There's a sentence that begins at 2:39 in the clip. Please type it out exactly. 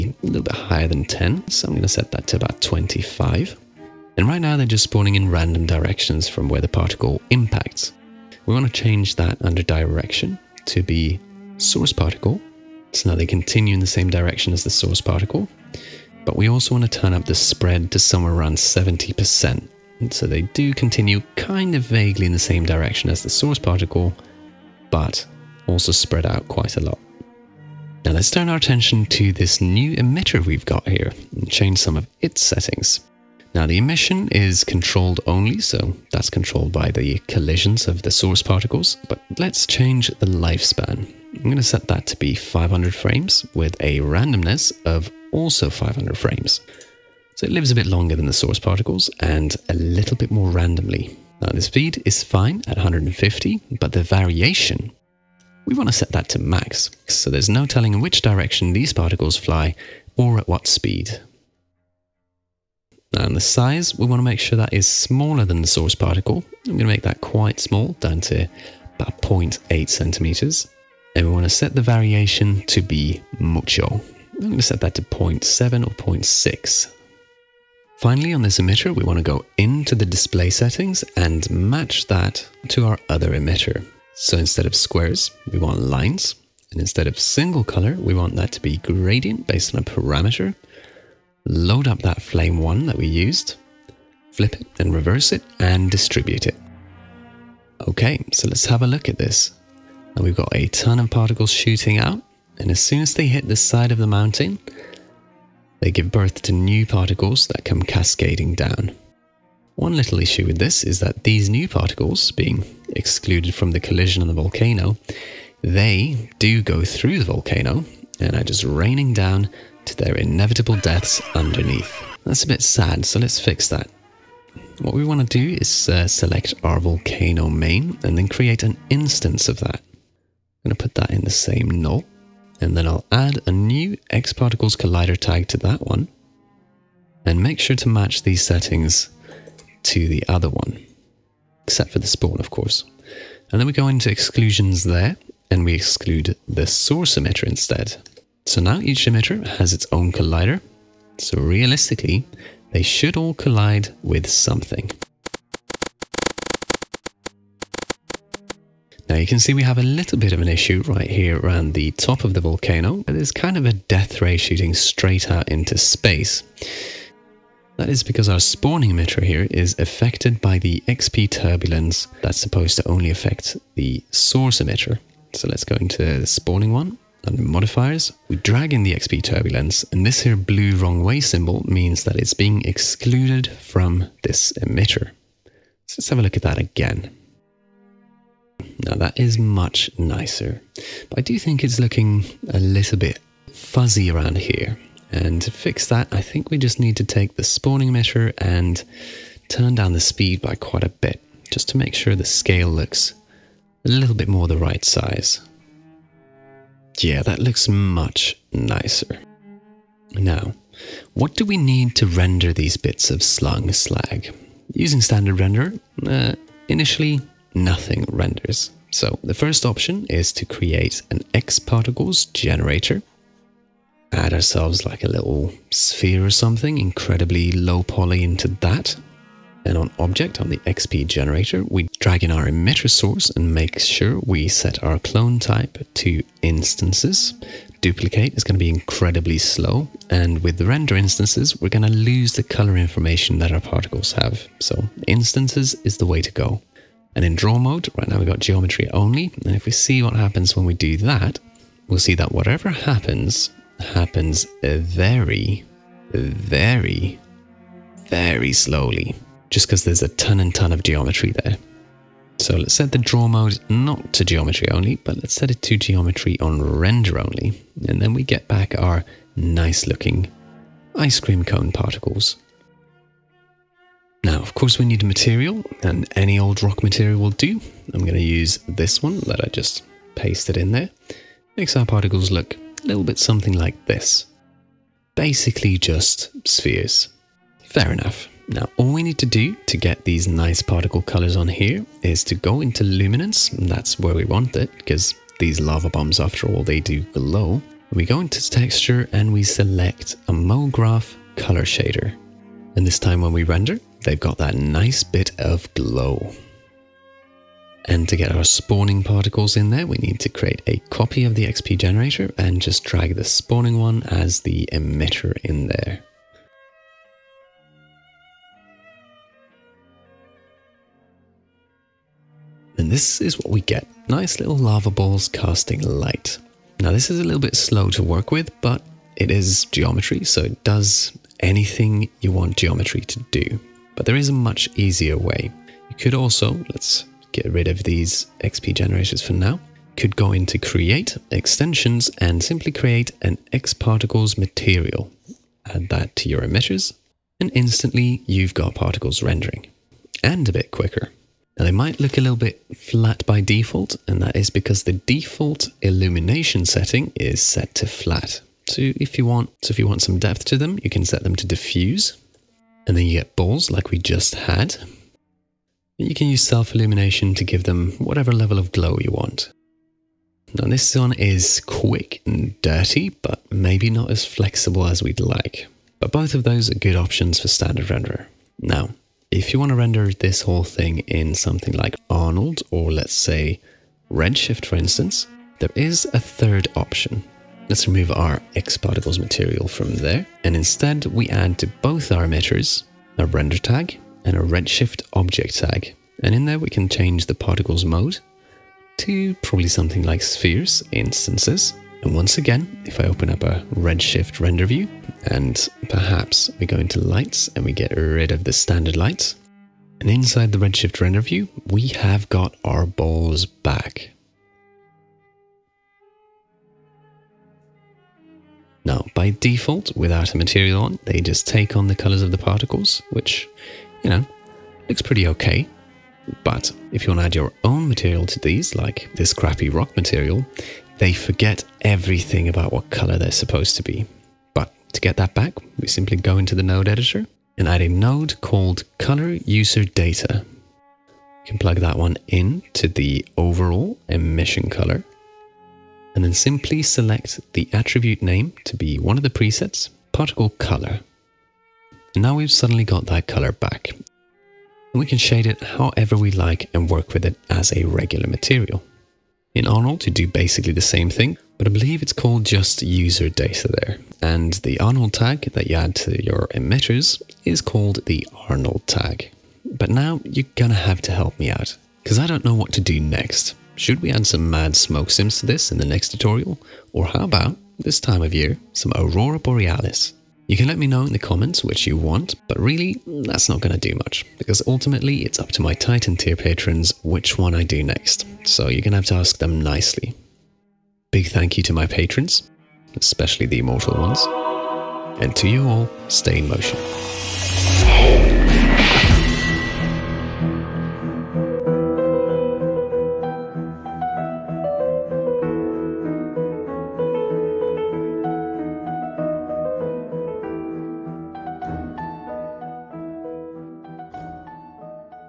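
Now you can see we have a little bit of an issue right here around the top of the volcano.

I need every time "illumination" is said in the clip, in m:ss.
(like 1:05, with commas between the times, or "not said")
5:55, 6:06.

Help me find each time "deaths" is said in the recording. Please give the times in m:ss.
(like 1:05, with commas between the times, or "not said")
2:00, 2:43.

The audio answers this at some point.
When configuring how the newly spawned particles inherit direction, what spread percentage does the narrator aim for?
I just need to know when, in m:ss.
0:18.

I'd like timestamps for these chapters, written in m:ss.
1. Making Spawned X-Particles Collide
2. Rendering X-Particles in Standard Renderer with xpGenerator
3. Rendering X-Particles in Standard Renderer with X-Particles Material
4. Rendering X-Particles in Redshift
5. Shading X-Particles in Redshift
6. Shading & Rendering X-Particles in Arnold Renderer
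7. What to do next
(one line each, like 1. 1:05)
1. 1:49
2. 3:30
3. 5:33
4. 6:18
5. 7:06
6. 7:39
7. 7:49.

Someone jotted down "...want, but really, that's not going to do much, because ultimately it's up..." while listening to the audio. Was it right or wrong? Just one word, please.
right.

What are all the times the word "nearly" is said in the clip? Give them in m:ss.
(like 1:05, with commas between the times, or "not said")
not said.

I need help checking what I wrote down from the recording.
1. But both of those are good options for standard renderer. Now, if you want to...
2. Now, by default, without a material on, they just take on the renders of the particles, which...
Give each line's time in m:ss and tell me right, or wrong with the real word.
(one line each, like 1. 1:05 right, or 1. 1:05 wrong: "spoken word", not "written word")
1. 6:15 right
2. 6:58 wrong: "colors", not "renders".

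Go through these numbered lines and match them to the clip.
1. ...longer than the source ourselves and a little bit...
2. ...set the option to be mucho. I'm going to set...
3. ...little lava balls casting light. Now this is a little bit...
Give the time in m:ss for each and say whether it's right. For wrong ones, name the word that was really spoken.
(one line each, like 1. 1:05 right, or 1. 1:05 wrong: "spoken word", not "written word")
1. 0:47 wrong: "particles", not "ourselves"
2. 1:11 wrong: "variation", not "option"
3. 5:24 right.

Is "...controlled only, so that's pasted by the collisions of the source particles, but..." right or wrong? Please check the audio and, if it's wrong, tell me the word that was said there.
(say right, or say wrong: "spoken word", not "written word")
wrong: "controlled", not "pasted".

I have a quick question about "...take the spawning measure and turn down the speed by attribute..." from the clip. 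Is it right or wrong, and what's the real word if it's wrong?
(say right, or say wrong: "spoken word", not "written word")
wrong: "quite", not "attribute".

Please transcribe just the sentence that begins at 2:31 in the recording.
So realistically, they should all collide with something.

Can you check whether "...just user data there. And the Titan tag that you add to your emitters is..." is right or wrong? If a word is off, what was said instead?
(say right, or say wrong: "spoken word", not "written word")
wrong: "Arnold", not "Titan".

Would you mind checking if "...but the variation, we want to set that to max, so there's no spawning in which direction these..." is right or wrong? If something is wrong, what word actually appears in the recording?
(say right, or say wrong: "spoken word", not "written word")
wrong: "telling", not "spawning".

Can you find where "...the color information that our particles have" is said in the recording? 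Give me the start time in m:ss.
4:02.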